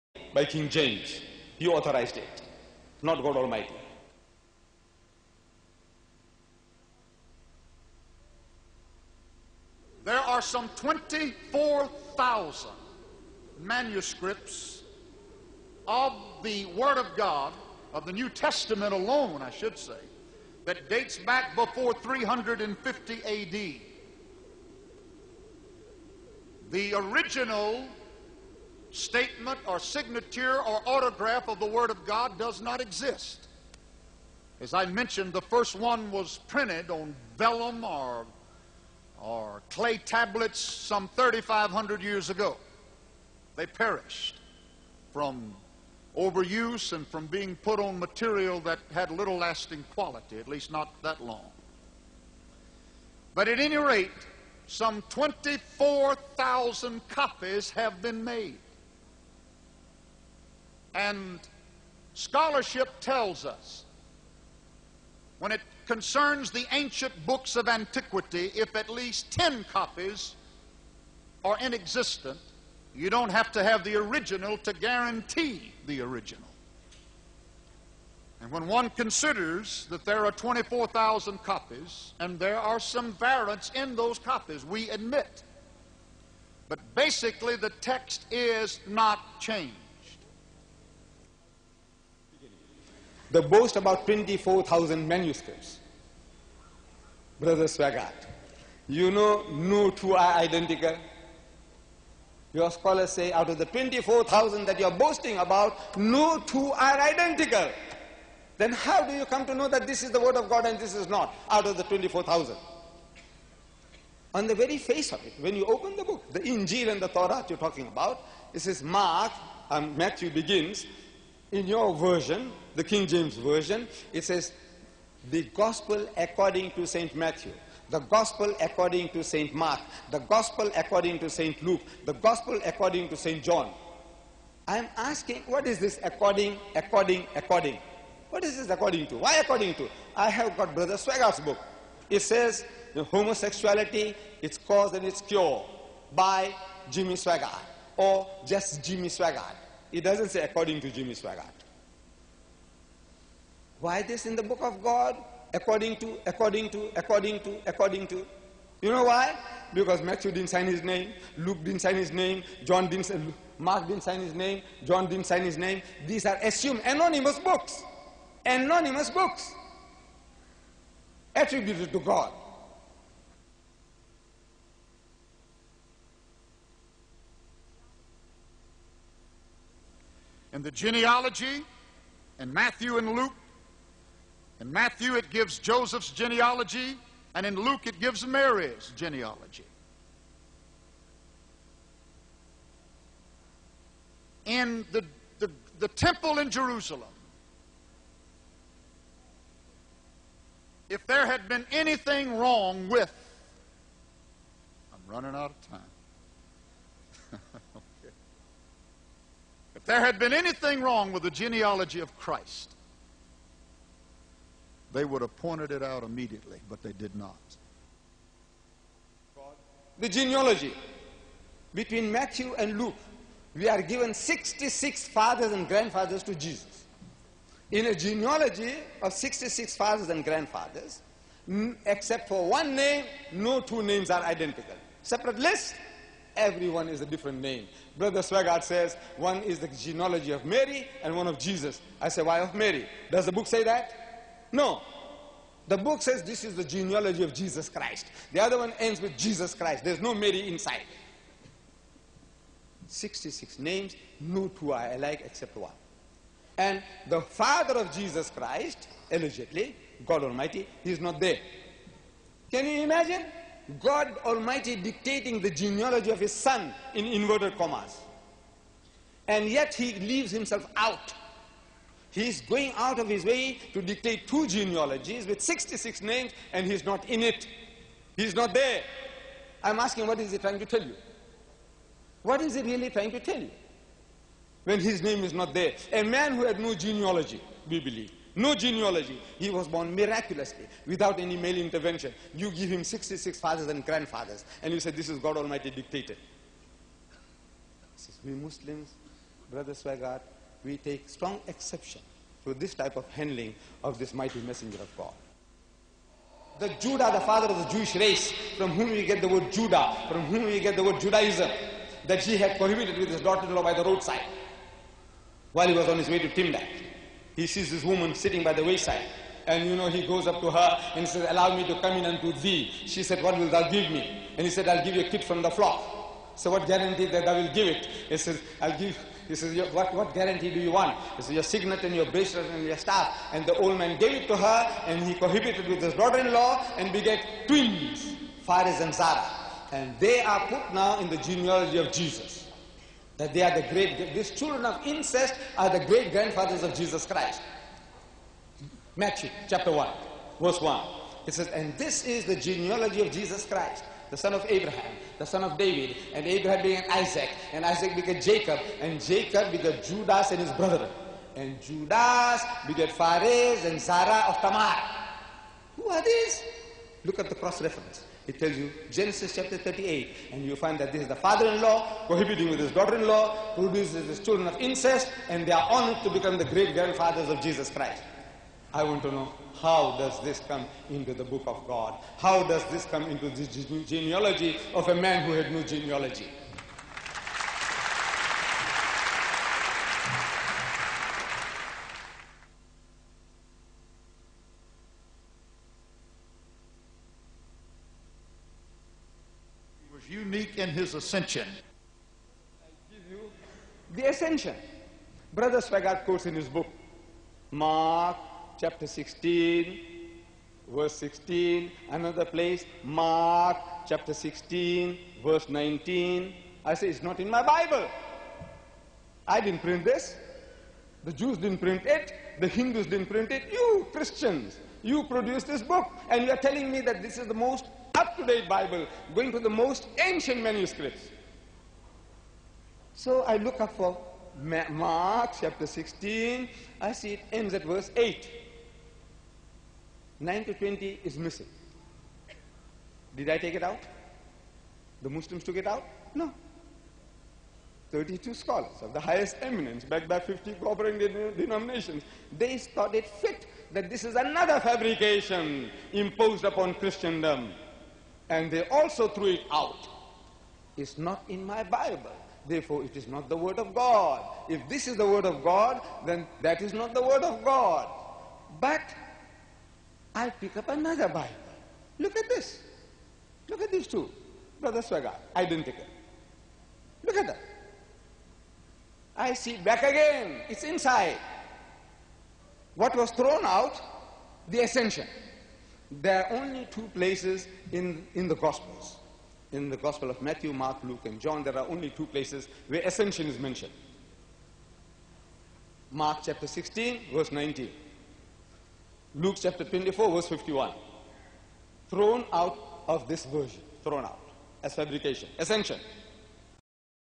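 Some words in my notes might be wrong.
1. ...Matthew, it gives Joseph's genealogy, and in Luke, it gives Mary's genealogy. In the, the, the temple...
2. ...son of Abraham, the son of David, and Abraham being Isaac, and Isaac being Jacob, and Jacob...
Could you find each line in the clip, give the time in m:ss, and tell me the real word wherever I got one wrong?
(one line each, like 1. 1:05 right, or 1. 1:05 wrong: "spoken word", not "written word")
1. 3:04 right
2. 5:54 right.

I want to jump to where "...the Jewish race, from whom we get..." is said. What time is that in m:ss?
5:07.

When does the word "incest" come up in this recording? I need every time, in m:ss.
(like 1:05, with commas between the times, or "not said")
5:44, 6:14.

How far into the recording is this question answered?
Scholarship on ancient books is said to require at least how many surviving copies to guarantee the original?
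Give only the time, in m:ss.
1:09.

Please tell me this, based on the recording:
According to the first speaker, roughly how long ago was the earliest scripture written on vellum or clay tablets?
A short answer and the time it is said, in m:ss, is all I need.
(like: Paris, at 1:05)
3,500 years, at 0:41.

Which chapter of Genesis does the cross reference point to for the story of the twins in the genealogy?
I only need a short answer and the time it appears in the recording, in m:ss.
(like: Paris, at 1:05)
Chapter 38, at 6:08.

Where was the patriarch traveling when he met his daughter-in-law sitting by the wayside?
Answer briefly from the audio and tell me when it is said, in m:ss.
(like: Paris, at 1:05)
Timnah, at 5:16.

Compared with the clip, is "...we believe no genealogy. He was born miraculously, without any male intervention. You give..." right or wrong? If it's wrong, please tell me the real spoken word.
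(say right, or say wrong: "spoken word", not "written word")
right.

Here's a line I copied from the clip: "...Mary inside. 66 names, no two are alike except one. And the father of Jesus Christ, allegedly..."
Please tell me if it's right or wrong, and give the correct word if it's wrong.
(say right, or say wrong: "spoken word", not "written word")
right.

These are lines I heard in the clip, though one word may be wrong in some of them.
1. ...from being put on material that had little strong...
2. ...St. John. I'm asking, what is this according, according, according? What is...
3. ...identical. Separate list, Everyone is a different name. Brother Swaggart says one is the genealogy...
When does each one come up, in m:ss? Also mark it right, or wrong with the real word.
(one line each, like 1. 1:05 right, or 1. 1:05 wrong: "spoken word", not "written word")
1. 0:47 wrong: "lasting", not "strong"
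2. 2:13 right
3. 3:54 right.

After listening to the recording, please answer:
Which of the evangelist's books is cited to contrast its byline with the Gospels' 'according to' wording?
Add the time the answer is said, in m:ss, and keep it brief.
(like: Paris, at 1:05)
Homosexuality, Its Cause and Its Cure, at 2:23.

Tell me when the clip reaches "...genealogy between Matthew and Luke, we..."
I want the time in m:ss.
3:40.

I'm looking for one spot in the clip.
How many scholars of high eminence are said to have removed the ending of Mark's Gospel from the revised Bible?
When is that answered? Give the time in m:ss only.
7:27.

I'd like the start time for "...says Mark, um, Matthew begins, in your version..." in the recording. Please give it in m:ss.
1:58.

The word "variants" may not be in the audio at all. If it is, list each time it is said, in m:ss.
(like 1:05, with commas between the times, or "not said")
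1:23.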